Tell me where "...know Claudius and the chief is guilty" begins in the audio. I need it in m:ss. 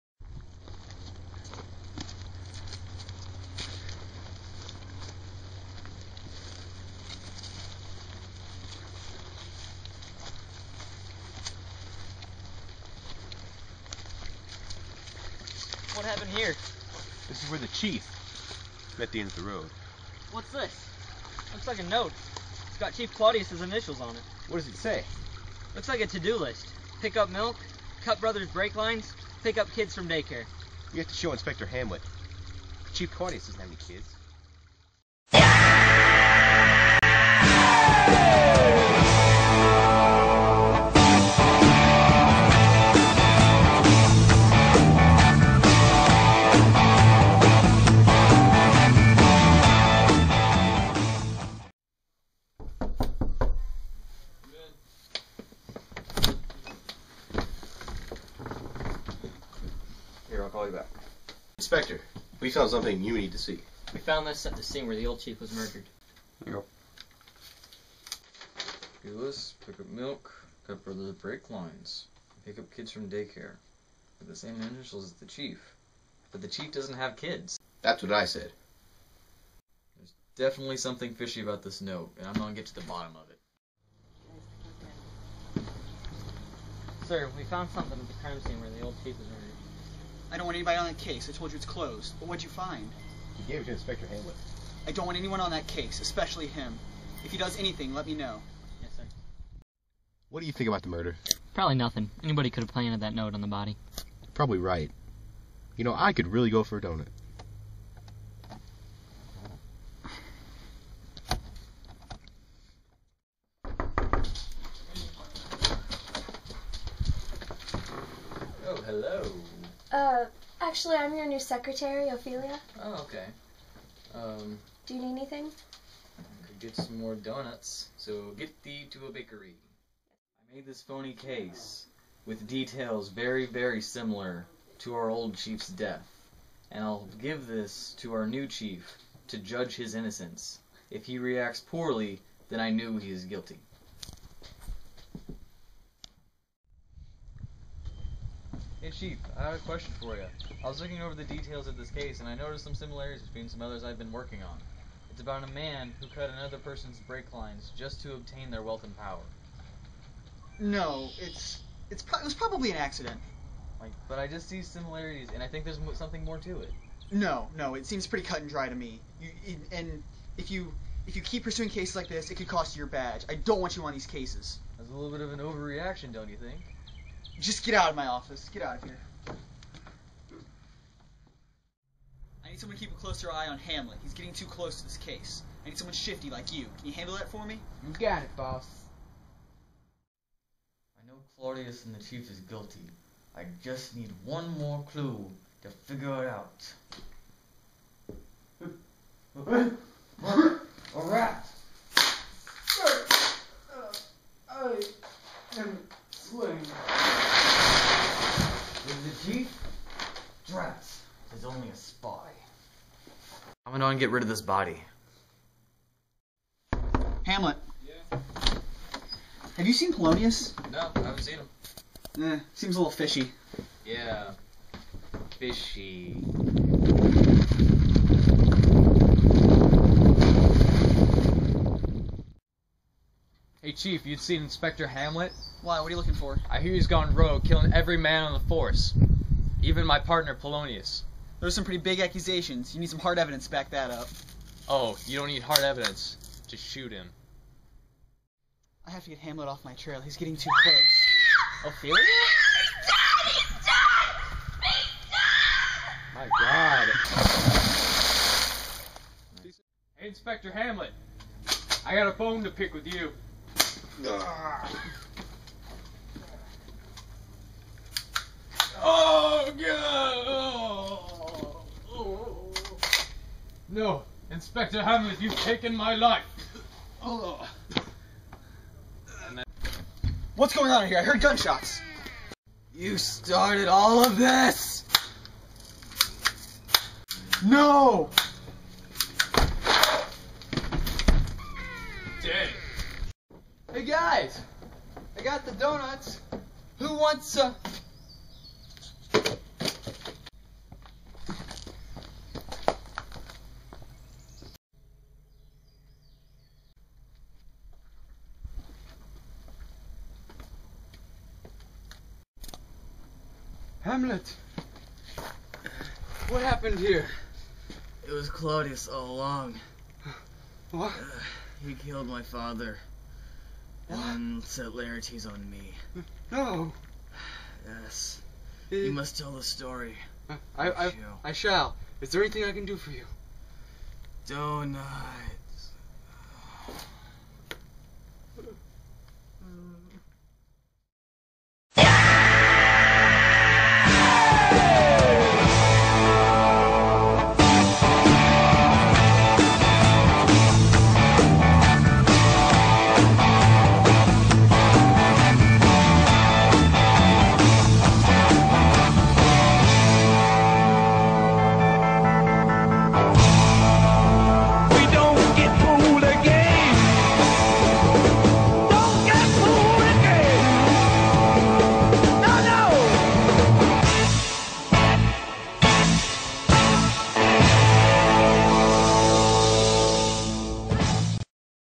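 3:11.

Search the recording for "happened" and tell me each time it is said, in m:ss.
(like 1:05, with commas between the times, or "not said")
0:16, 5:16.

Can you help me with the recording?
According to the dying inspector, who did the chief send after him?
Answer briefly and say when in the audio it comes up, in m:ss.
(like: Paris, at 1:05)
Laertes, at 5:24.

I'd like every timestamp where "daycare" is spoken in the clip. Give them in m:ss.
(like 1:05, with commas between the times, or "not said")
0:30, 1:13.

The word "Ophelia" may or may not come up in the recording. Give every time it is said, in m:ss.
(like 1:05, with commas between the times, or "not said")
2:02, 4:11.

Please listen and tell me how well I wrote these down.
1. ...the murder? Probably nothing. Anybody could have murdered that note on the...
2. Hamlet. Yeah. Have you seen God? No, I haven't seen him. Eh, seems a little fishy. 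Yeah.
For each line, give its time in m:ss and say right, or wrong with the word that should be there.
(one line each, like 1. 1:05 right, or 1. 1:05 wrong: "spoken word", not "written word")
1. 1:40 wrong: "planted", not "murdered"
2. 3:37 wrong: "Polonius", not "God".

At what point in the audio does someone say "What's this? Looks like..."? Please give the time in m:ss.
0:20.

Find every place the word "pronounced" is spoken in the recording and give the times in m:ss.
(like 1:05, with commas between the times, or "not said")
not said.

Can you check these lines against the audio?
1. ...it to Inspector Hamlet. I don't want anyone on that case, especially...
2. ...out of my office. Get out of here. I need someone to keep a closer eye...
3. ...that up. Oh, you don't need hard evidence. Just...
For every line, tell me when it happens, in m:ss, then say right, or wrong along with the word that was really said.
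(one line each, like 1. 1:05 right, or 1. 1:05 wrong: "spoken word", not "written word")
1. 1:33 right
2. 2:57 right
3. 4:03 right.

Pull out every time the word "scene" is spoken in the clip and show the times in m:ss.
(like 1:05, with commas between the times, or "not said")
1:04, 1:28.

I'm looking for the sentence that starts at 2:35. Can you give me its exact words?
It's about a man who cut another person's brake lines just to obtain their wealth and power.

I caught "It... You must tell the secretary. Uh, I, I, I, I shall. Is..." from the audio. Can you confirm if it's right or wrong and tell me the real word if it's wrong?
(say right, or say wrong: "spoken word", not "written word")
wrong: "story", not "secretary".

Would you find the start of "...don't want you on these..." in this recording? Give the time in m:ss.
2:53.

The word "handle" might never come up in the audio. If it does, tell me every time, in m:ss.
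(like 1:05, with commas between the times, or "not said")
3:06.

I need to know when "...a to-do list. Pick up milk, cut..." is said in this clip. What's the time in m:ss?
0:25.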